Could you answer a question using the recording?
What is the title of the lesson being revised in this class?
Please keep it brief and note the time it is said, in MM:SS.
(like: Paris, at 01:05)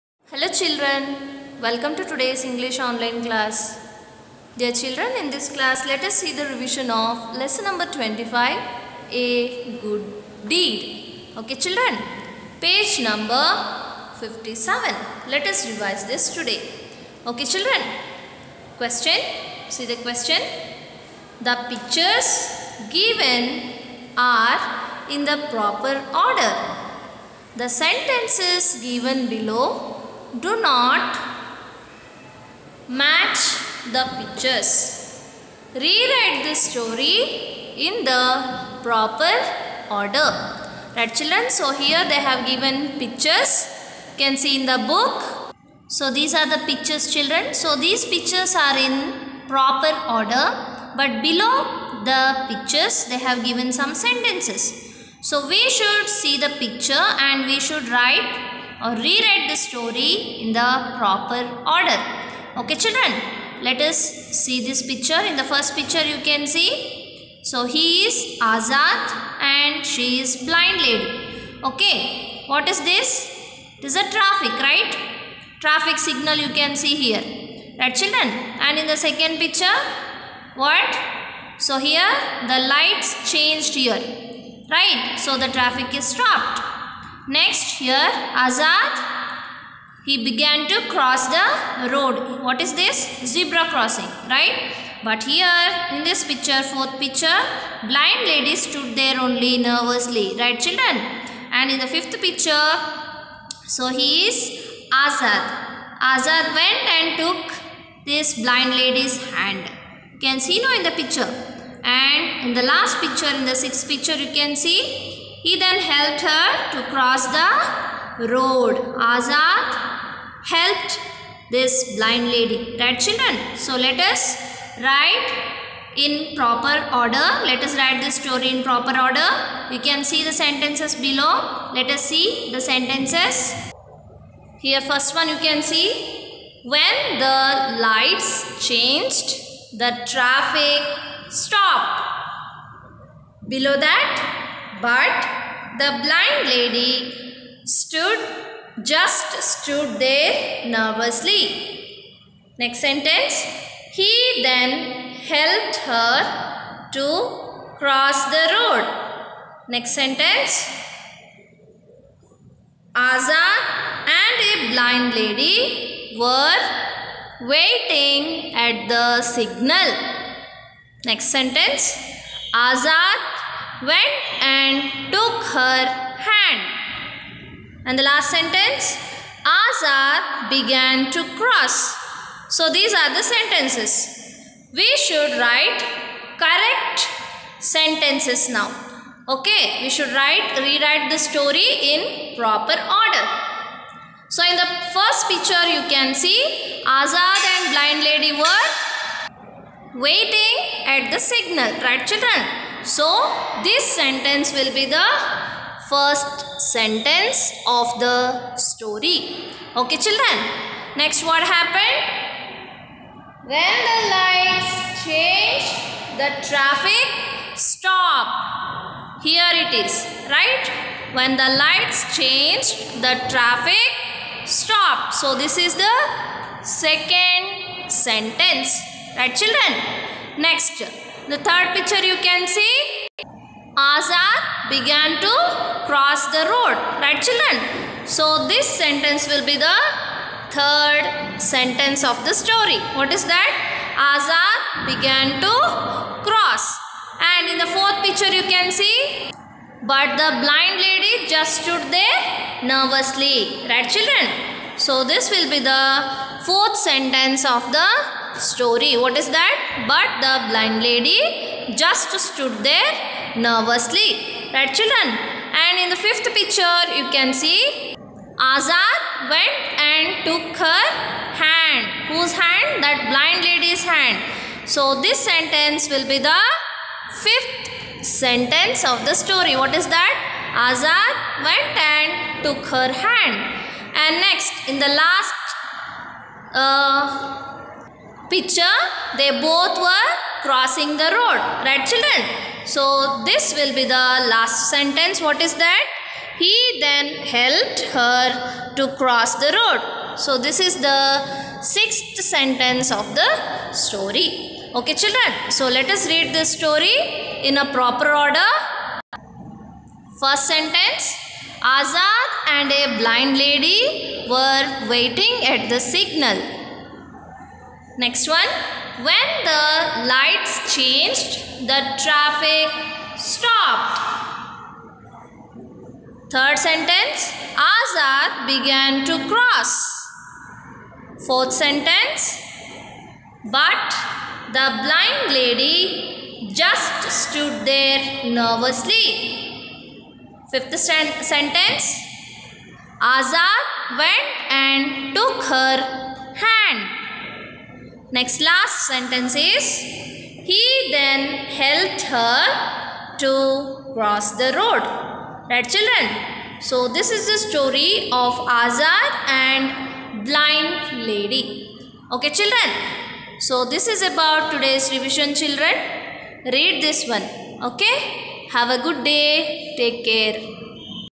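A Good Deed, at 00:09.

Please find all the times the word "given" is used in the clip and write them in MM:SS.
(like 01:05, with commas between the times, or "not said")
00:22, 00:28, 00:42, 00:53.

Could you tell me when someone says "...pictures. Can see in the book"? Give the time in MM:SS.
00:42.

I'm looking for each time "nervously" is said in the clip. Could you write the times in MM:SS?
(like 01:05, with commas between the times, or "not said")
01:39, 02:30, 04:12, 04:23, 05:38.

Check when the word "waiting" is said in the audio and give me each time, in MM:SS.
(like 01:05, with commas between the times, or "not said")
02:47, 03:19, 05:14.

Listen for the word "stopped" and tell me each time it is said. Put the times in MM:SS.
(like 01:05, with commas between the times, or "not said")
01:26, 02:21, 03:37, 03:44, 05:23.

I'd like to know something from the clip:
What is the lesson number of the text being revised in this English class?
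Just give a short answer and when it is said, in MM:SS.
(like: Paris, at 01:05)
25, at 00:07.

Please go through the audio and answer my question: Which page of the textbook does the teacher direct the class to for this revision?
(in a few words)
57.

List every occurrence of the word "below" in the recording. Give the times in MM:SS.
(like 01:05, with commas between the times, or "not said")
00:29, 00:51, 02:10, 02:23.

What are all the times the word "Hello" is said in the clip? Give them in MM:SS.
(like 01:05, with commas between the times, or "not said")
00:00.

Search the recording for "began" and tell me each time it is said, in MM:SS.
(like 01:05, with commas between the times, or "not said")
01:30, 03:00, 03:54, 04:04, 05:28.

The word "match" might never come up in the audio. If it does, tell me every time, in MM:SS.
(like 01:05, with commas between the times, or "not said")
00:32.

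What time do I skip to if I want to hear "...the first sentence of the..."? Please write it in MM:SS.
03:24.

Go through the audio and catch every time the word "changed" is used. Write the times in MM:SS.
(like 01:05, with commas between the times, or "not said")
01:23, 02:18, 03:35, 03:42, 05:20.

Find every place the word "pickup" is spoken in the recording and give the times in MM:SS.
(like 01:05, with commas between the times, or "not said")
not said.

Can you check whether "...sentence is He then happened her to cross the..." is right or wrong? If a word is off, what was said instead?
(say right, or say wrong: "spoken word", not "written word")
wrong: "helped", not "happened".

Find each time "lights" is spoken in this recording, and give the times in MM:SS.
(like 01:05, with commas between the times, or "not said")
01:22, 02:17, 03:34, 03:41, 05:20.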